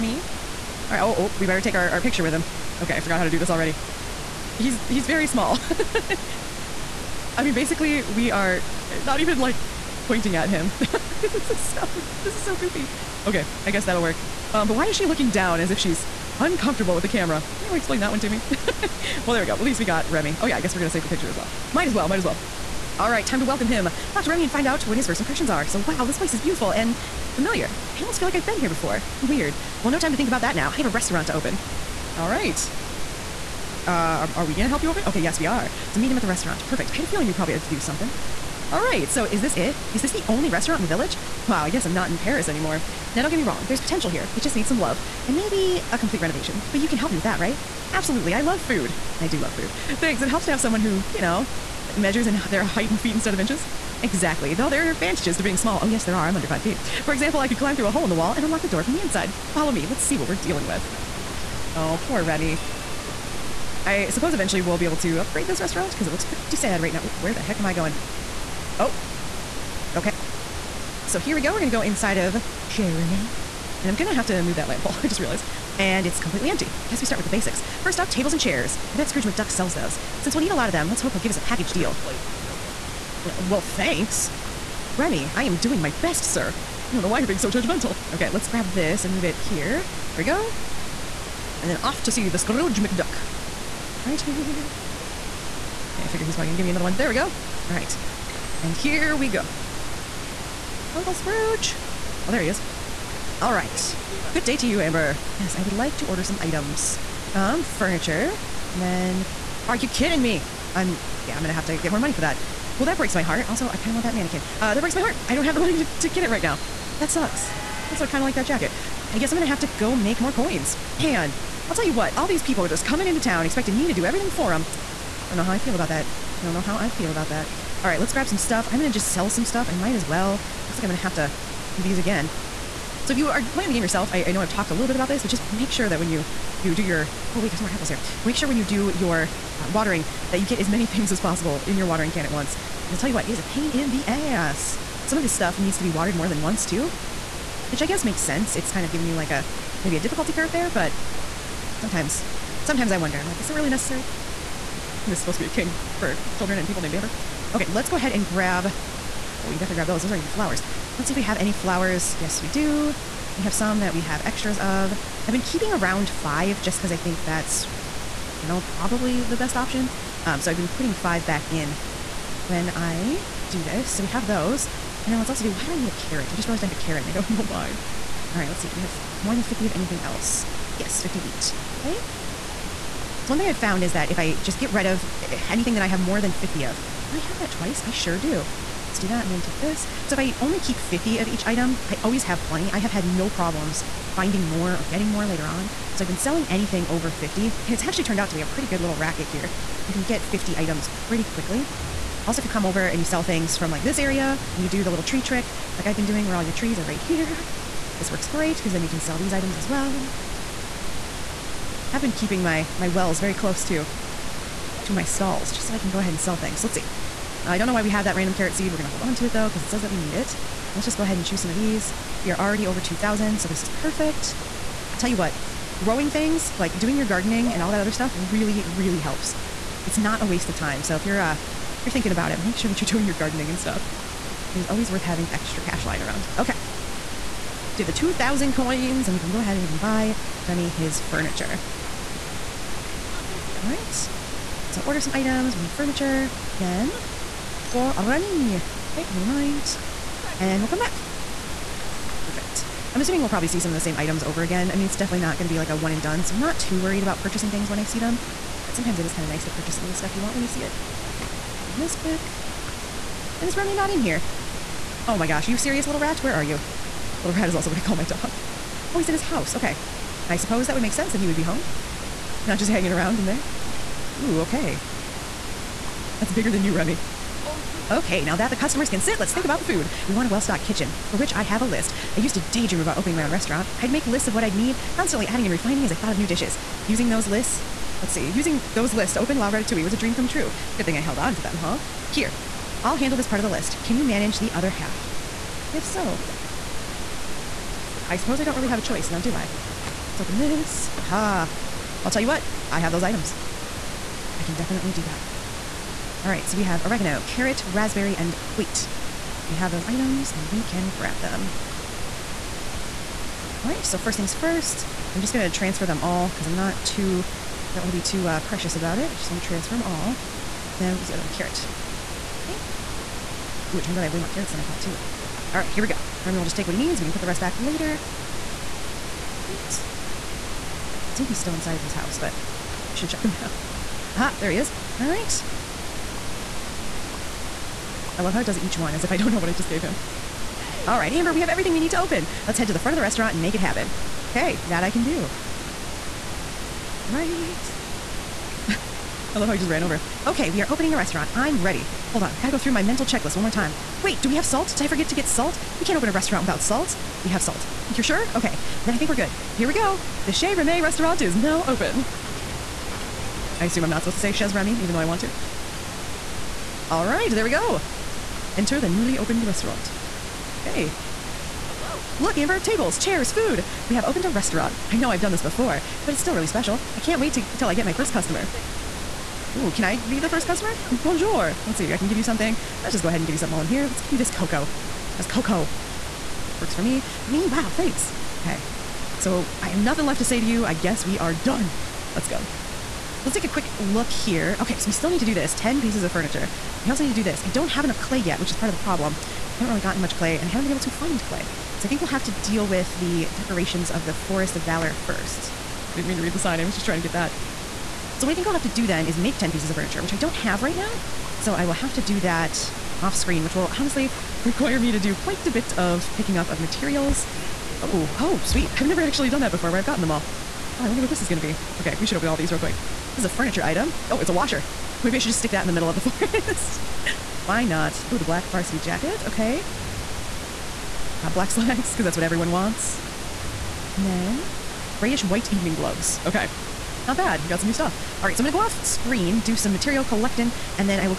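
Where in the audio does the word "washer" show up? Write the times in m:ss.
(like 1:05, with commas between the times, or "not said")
7:04.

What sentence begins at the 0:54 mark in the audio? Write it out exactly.
Exactly, though there are advantages to being small.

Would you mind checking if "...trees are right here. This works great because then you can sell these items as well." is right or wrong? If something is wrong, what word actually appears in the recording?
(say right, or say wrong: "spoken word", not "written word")
right.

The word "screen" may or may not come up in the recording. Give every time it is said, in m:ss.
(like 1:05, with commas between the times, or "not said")
6:53, 7:18.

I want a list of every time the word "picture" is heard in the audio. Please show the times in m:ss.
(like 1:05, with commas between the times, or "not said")
0:01, 0:21.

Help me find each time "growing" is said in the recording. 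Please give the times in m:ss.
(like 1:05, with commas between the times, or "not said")
3:45.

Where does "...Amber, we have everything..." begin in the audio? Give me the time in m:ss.
5:41.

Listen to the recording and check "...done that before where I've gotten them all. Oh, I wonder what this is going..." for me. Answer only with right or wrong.
right.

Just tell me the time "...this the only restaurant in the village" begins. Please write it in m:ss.
0:40.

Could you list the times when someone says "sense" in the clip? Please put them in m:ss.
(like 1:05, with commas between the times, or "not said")
2:28, 4:30.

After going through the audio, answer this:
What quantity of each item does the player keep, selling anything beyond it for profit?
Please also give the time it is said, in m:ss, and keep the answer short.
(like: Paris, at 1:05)
50, at 3:10.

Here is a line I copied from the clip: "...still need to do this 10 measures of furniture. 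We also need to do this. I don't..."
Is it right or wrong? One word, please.
wrong.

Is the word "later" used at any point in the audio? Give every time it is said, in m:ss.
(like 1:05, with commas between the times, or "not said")
3:15, 5:27.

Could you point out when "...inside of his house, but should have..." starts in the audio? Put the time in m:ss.
5:31.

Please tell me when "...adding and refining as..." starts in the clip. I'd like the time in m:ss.
4:45.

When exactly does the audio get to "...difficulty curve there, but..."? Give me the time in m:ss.
2:29.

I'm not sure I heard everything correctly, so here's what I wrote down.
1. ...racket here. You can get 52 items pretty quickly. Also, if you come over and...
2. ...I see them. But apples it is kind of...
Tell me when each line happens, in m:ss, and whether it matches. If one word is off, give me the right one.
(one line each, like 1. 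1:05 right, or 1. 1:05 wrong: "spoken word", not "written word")
1. 3:18 wrong: "50", not "52"
2. 4:17 wrong: "sometimes", not "apples".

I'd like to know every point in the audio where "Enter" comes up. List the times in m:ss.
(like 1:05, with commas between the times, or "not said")
6:08.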